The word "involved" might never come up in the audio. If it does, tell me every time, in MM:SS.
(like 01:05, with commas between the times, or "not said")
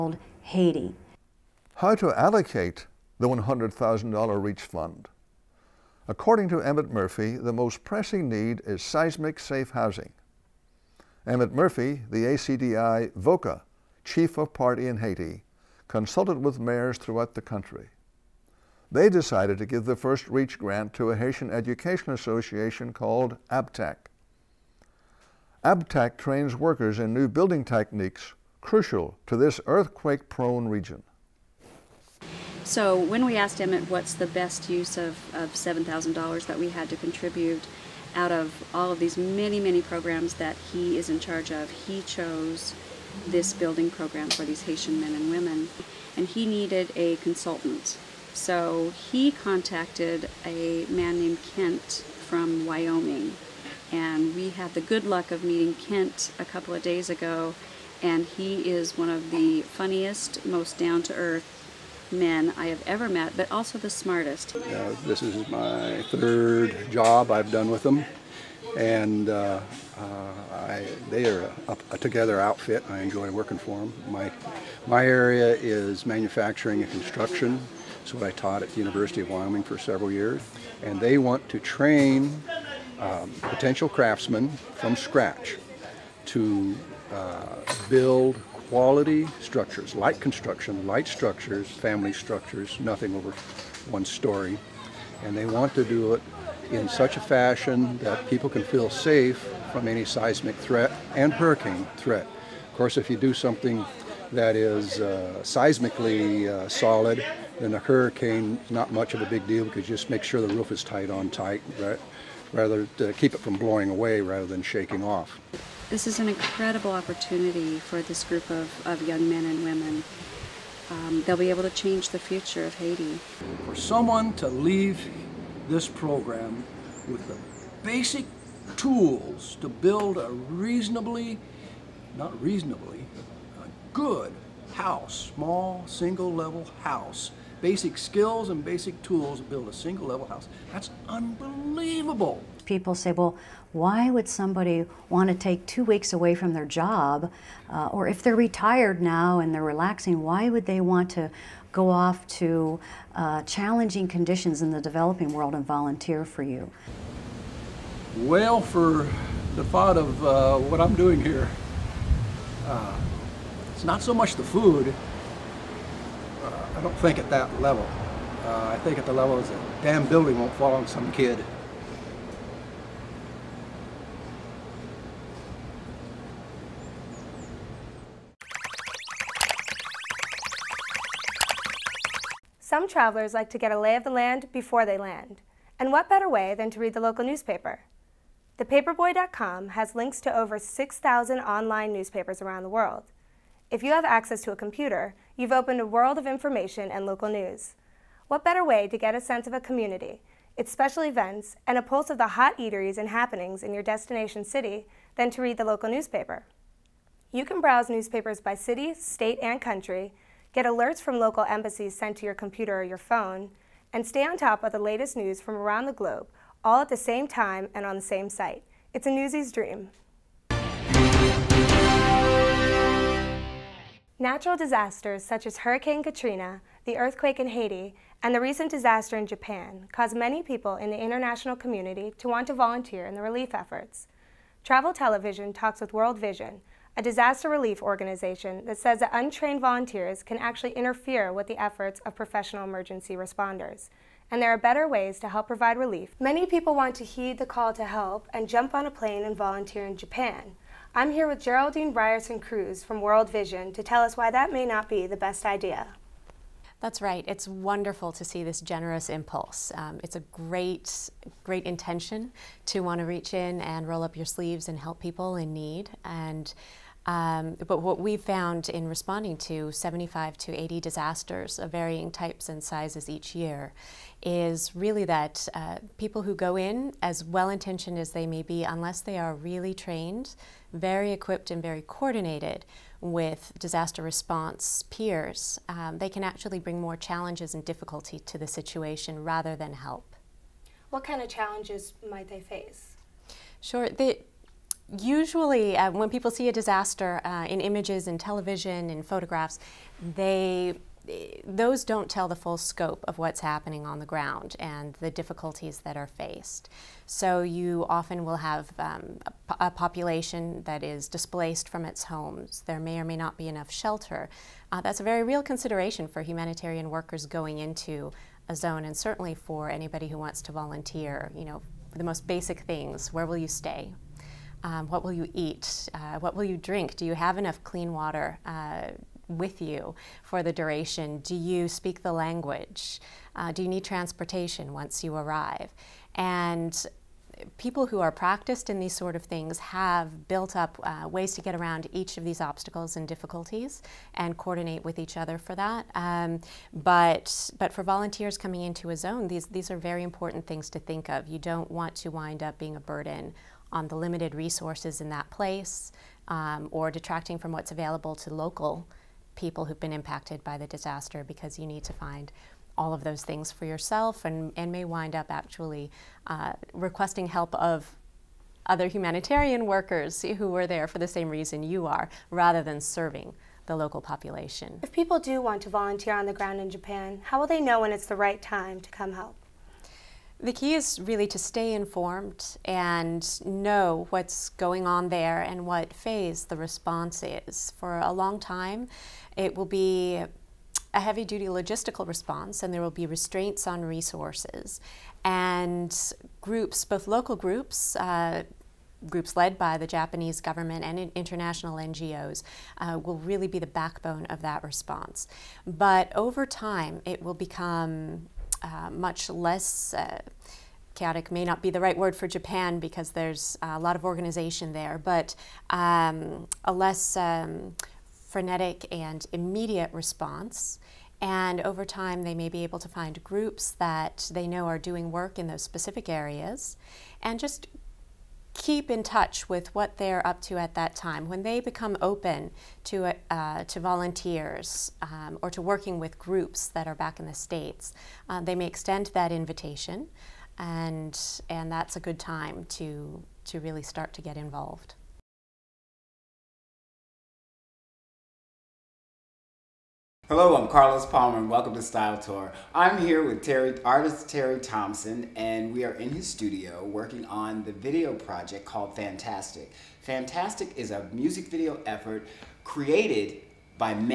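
07:24.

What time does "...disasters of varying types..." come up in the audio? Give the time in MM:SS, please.
04:30.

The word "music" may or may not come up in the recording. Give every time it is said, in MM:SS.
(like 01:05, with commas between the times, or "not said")
07:41.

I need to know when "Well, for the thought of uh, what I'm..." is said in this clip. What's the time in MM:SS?
02:38.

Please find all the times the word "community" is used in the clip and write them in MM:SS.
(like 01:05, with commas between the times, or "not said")
03:19, 03:51.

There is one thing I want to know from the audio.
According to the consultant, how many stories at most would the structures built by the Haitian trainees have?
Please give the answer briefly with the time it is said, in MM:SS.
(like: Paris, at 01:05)
one story, at 01:33.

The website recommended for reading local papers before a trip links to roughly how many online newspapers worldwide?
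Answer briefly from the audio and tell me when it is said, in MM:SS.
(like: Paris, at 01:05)
6,000, at 03:10.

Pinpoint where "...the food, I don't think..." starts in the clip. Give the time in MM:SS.
02:44.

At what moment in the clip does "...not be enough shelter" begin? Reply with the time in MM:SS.
05:13.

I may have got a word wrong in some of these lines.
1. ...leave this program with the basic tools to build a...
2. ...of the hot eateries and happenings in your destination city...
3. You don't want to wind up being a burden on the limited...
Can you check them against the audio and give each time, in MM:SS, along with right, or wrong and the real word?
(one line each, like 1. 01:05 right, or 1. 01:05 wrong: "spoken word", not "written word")
1. 02:04 right
2. 03:22 right
3. 05:51 right.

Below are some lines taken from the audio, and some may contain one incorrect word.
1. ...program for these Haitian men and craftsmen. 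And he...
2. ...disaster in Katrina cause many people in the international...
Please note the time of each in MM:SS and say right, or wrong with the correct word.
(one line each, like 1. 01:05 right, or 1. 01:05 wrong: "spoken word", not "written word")
1. 00:43 wrong: "women", not "craftsmen"
2. 03:48 wrong: "Japan", not "Katrina".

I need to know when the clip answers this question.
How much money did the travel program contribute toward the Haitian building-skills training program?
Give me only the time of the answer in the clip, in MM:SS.
00:35.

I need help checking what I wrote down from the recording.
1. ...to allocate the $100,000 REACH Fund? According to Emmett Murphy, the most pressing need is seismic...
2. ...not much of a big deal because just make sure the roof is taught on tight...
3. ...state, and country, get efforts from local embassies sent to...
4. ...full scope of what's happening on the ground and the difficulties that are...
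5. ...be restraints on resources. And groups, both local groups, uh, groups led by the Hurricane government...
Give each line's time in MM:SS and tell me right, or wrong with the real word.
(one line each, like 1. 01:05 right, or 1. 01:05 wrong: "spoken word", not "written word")
1. 00:01 right
2. 01:48 wrong: "tight", not "taught"
3. 03:28 wrong: "alerts", not "efforts"
4. 05:02 right
5. 06:32 wrong: "Japanese", not "Hurricane".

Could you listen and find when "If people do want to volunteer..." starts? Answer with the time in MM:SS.
06:14.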